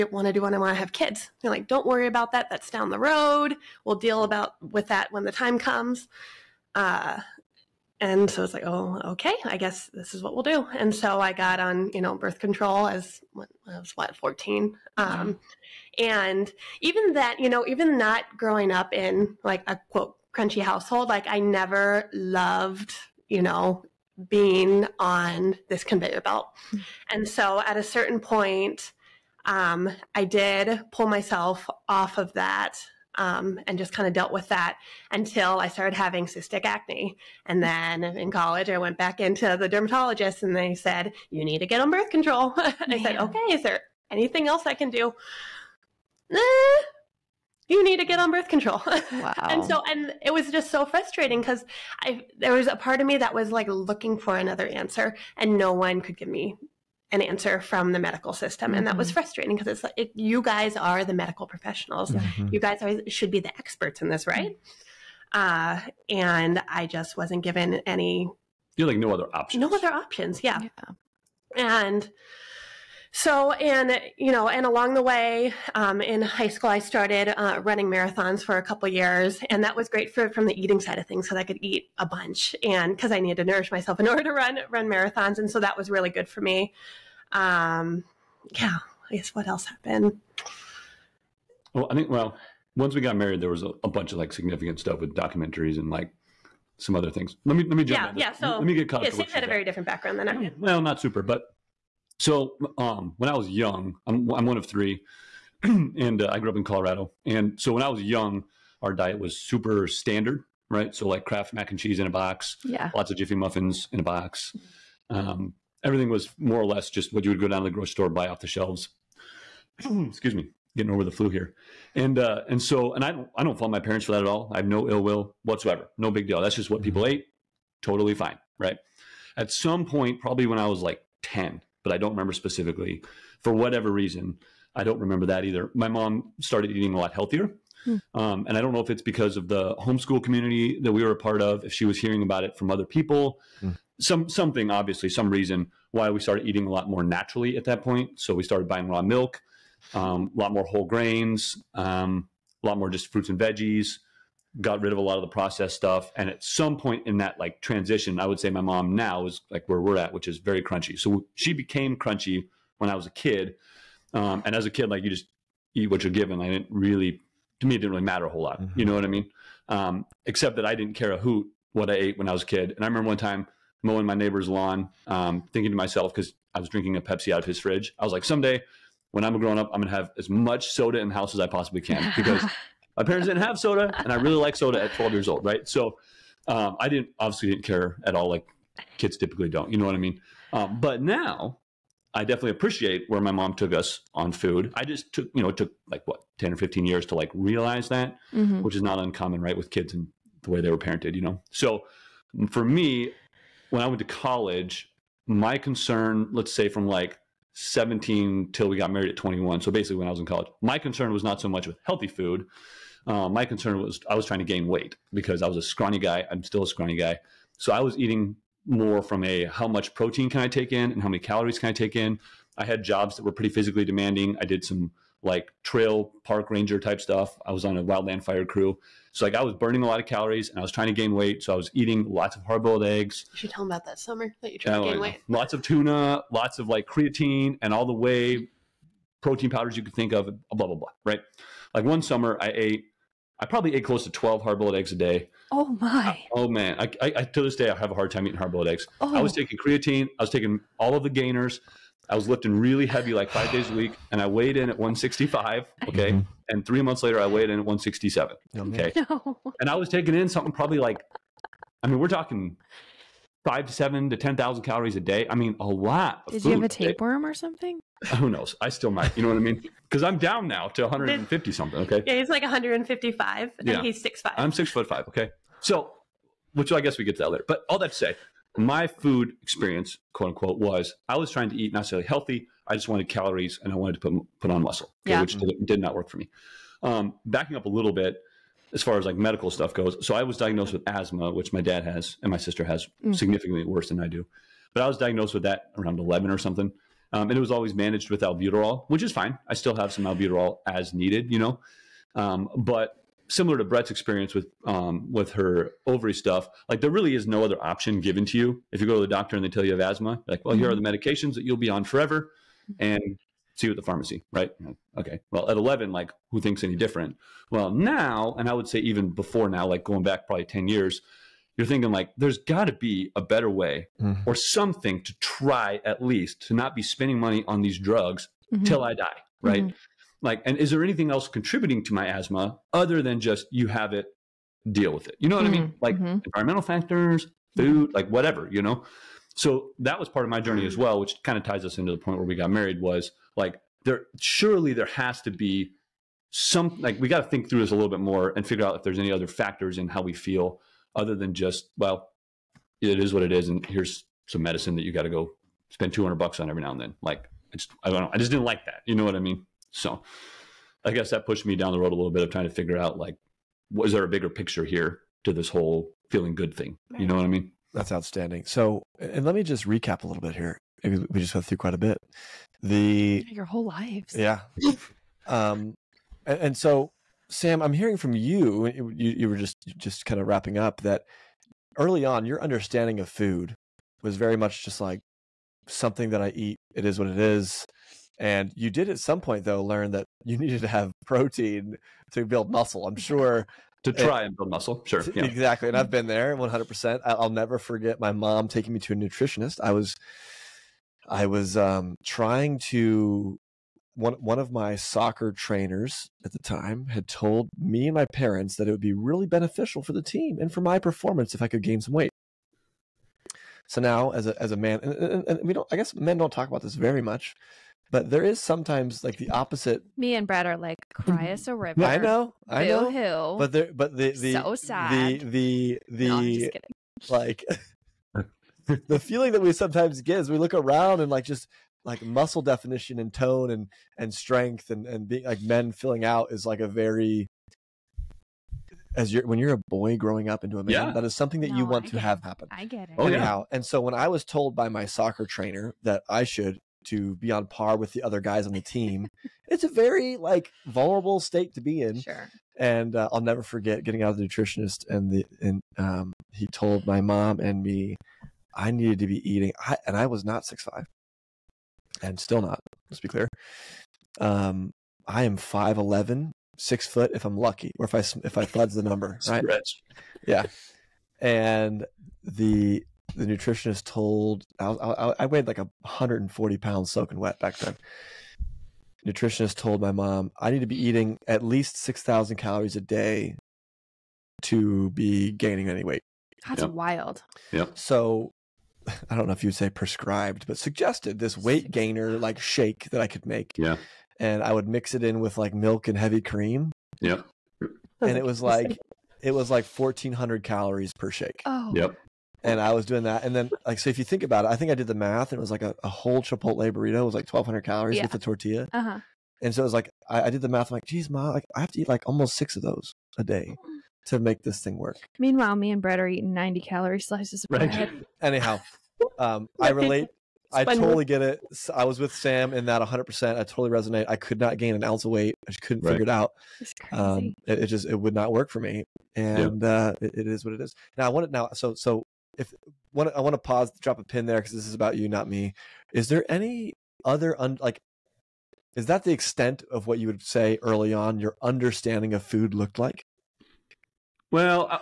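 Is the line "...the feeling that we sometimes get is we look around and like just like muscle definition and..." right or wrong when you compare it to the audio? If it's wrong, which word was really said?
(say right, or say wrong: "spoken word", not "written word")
right.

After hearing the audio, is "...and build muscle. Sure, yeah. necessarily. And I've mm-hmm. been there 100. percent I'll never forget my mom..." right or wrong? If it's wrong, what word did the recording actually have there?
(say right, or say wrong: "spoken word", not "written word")
wrong: "exactly", not "necessarily".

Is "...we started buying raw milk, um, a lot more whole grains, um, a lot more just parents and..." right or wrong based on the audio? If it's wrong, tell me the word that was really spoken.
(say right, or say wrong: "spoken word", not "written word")
wrong: "fruits", not "parents".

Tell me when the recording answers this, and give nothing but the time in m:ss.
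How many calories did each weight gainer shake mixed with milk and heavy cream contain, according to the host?
8:19.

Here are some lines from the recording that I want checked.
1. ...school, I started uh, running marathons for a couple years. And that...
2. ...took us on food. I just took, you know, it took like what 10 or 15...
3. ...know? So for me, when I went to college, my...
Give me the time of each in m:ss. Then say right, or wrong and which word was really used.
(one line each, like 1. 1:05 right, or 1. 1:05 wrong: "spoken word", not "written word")
1. 1:16 right
2. 3:13 right
3. 3:21 right.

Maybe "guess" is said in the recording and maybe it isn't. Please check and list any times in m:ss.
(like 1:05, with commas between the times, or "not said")
0:09, 1:29, 4:36, 6:00, 6:55.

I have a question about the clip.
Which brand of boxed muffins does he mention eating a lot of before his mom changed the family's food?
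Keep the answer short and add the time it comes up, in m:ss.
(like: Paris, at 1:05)
Jiffy, at 1:53.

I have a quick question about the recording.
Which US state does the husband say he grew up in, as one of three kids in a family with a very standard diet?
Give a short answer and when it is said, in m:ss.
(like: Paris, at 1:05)
Colorado, at 1:46.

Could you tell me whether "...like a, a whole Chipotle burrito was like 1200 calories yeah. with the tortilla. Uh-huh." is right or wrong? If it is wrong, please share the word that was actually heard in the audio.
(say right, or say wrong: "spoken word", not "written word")
right.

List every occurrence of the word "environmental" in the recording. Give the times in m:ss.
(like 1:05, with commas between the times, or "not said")
5:36.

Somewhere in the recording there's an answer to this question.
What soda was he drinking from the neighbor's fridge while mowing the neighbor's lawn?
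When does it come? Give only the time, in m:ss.
2:57.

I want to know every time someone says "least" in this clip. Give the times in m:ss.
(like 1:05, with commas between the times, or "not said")
5:26, 8:01.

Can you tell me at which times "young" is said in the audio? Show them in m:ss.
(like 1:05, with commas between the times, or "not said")
1:43, 1:48.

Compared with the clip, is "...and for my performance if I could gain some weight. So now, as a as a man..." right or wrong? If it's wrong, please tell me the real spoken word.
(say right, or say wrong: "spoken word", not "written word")
right.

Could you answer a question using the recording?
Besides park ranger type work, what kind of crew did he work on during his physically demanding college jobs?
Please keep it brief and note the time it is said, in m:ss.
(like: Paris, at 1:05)
wildland fire crew, at 3:47.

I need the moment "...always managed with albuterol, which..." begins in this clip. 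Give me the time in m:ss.
4:57.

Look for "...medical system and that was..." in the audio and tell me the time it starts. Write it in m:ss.
0:57.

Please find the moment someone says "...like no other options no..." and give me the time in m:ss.
1:08.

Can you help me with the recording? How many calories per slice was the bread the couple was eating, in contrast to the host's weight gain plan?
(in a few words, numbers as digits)
90.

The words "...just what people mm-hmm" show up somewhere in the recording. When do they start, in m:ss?
2:06.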